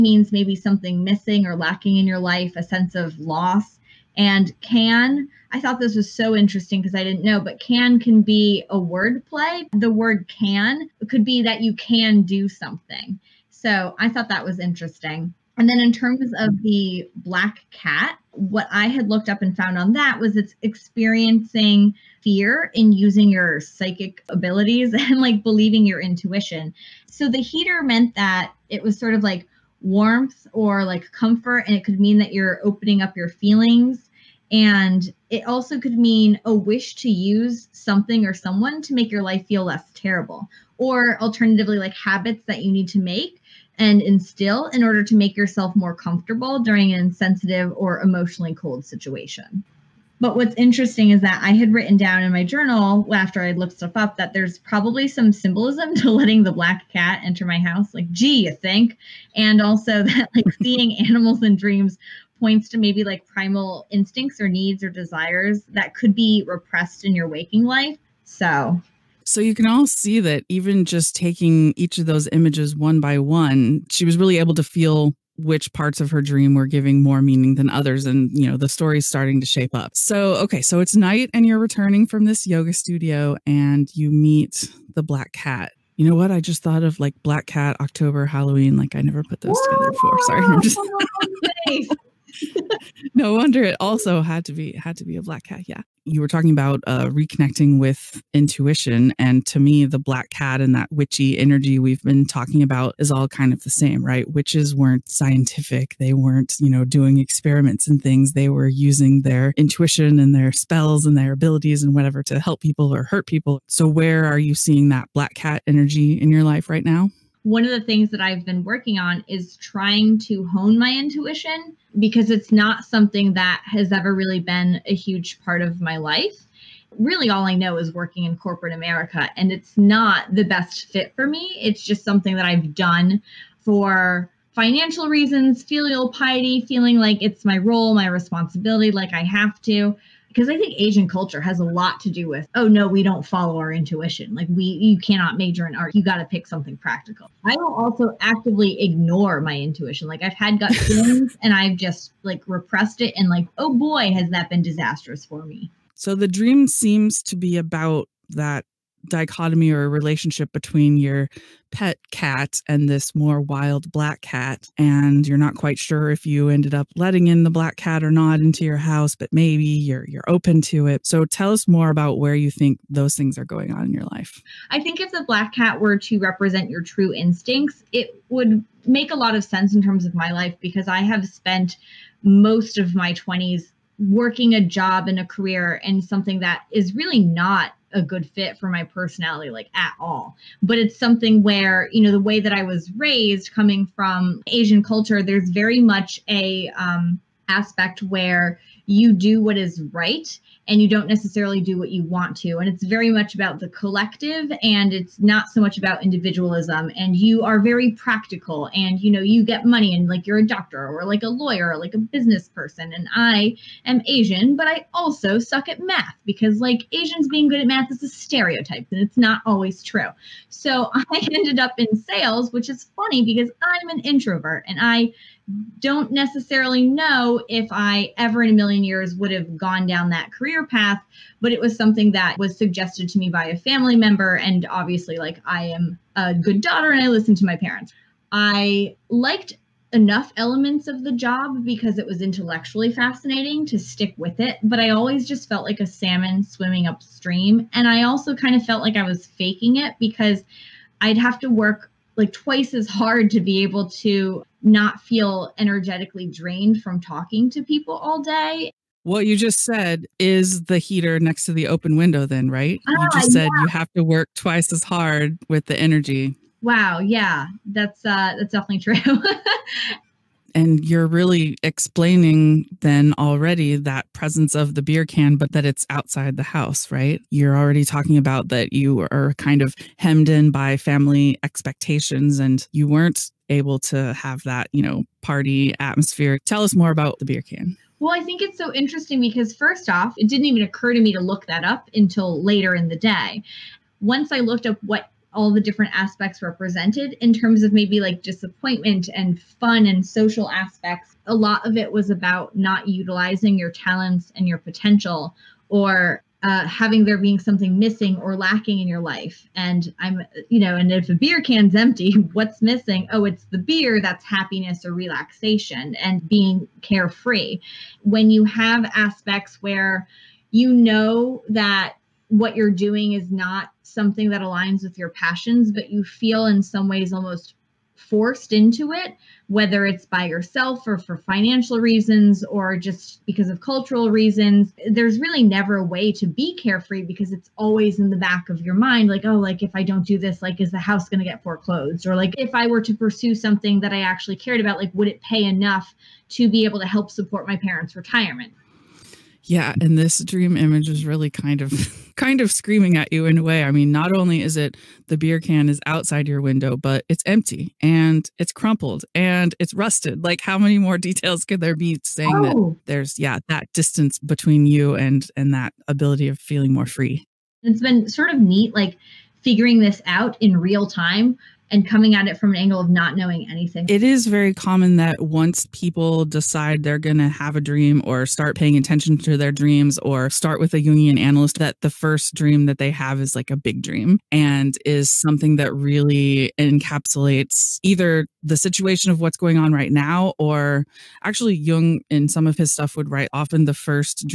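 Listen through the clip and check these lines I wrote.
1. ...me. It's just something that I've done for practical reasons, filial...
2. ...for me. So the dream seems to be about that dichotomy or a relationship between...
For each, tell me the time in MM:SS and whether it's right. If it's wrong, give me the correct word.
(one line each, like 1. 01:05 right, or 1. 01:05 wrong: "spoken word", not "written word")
1. 02:11 wrong: "financial", not "practical"
2. 02:35 right.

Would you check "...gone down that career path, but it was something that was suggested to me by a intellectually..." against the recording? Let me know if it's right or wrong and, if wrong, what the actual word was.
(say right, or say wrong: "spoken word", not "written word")
wrong: "family", not "intellectually".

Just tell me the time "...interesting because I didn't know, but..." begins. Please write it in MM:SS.
00:06.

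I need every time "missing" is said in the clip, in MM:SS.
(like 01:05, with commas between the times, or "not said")
00:01, 05:07, 05:12.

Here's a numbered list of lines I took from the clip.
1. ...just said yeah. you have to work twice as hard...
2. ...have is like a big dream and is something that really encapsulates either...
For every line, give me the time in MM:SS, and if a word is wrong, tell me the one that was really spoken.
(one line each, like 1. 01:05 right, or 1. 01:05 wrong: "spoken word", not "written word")
1. 04:23 right
2. 06:22 right.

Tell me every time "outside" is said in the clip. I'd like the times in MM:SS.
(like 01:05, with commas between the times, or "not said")
04:35, 05:55.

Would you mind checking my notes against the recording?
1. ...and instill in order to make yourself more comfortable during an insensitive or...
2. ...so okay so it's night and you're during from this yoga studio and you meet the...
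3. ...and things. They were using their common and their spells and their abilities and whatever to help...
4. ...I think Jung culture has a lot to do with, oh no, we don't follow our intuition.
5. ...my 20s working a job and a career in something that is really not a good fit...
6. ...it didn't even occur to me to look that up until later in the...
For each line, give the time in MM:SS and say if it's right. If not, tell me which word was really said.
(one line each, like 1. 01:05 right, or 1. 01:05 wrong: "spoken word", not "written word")
1. 00:43 right
2. 01:19 wrong: "returning", not "during"
3. 01:47 wrong: "intuition", not "common"
4. 02:20 wrong: "Asian", not "Jung"
5. 03:02 right
6. 04:50 right.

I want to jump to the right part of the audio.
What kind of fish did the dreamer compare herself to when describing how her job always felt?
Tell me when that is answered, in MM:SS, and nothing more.
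04:05.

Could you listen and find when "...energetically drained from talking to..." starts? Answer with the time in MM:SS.
04:15.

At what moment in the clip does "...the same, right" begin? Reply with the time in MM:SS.
01:43.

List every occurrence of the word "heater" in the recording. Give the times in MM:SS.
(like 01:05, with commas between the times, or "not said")
00:27, 04:20.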